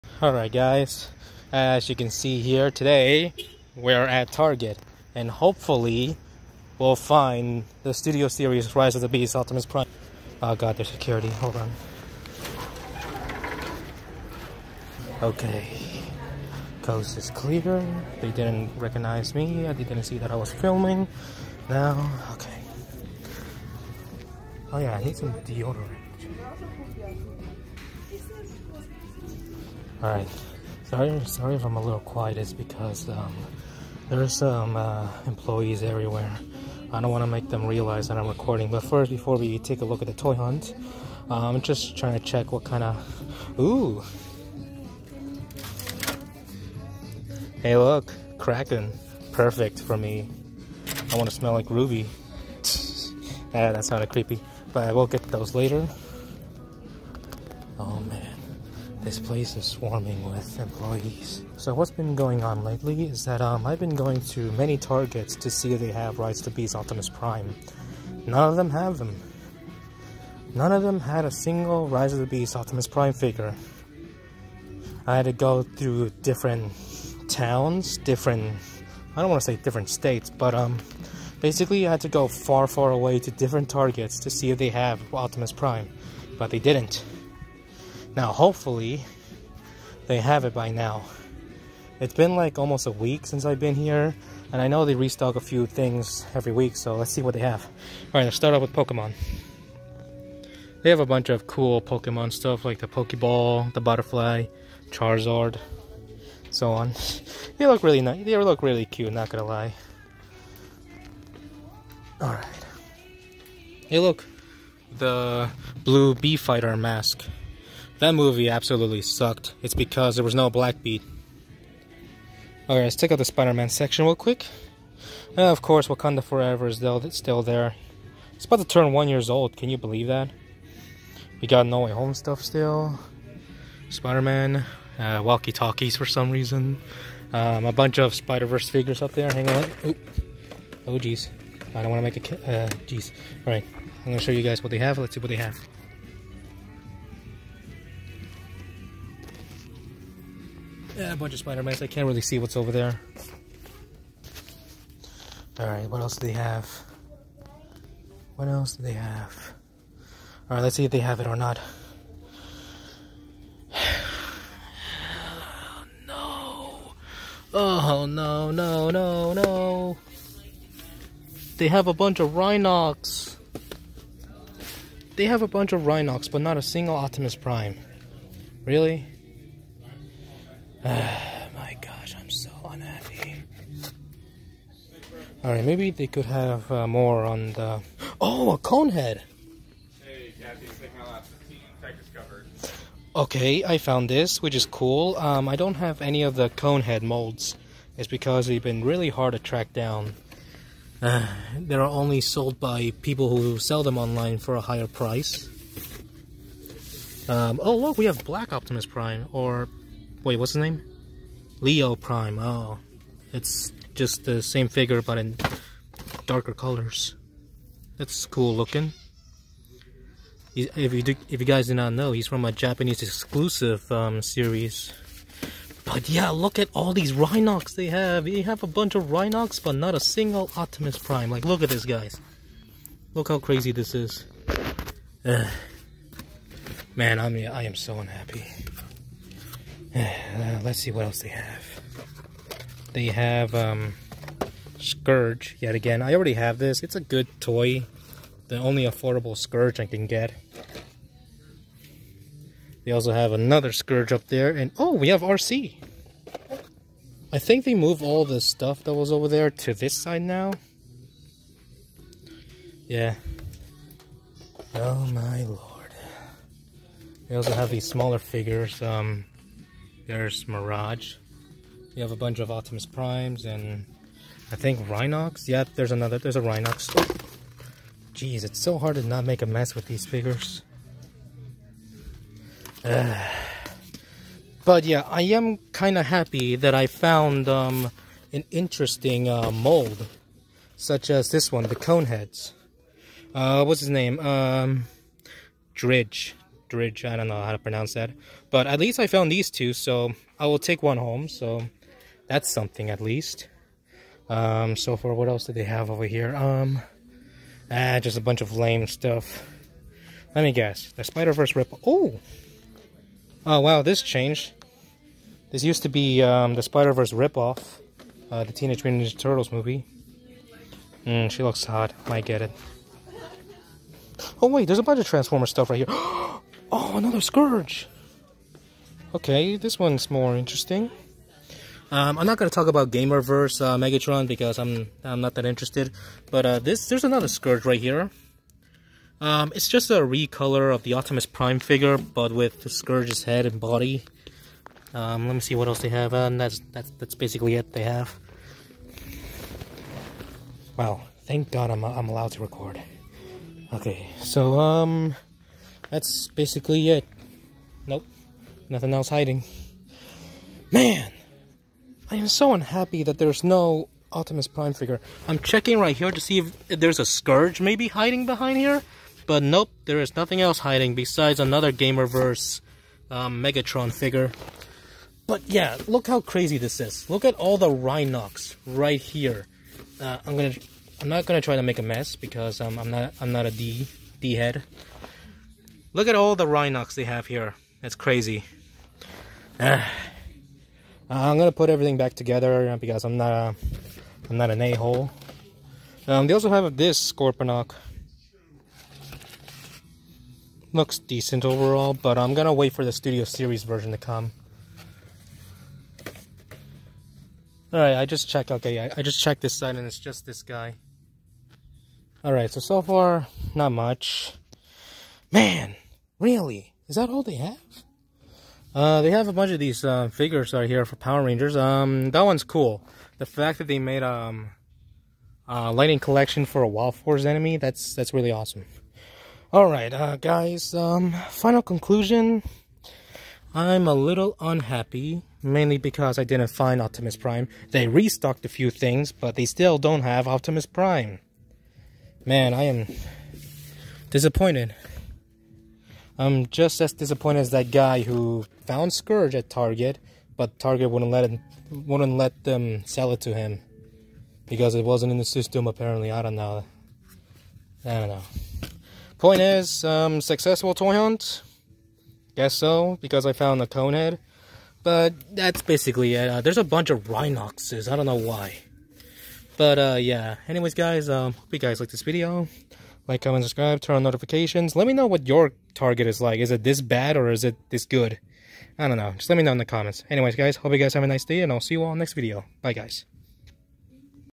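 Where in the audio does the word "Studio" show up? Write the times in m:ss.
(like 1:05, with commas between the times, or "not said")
0:07, 6:42.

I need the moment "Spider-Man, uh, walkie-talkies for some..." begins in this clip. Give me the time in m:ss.
2:13.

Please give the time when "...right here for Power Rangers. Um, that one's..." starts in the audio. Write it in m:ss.
7:00.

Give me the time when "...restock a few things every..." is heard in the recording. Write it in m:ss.
1:34.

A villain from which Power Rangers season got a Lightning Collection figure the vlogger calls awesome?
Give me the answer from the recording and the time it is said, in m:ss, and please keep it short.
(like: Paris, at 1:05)
Wild Force, at 7:06.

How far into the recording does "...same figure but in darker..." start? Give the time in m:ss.
3:34.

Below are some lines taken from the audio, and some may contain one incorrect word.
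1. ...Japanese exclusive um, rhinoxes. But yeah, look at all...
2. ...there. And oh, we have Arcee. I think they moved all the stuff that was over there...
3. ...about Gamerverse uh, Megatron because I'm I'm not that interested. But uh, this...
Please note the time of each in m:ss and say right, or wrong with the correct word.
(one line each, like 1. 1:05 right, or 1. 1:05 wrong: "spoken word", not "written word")
1. 3:42 wrong: "series", not "rhinoxes"
2. 4:14 right
3. 5:32 right.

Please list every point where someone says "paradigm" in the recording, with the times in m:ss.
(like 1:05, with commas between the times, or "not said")
not said.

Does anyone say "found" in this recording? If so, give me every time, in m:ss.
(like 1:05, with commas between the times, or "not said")
3:13, 4:46, 4:59, 7:28, 7:43.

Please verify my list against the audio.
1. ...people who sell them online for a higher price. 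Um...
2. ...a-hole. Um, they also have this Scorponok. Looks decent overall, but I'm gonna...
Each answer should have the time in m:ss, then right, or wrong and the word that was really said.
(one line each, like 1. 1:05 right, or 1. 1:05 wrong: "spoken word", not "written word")
1. 3:23 right
2. 6:34 right.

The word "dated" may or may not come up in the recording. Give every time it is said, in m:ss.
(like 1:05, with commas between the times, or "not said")
not said.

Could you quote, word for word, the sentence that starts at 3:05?
Alright, maybe they could have uh, more on the...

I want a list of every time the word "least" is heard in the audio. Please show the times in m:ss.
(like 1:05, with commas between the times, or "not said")
4:58, 5:03.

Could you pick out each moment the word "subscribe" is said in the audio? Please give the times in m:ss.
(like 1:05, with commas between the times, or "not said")
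7:53.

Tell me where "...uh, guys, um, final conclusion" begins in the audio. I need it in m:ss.
7:09.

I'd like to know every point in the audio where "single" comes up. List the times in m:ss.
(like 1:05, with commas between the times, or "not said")
1:11, 2:56, 3:49.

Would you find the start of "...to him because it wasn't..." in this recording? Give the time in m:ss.
7:33.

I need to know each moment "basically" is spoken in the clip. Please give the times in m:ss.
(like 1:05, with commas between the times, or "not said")
1:21, 5:47, 5:56, 7:45.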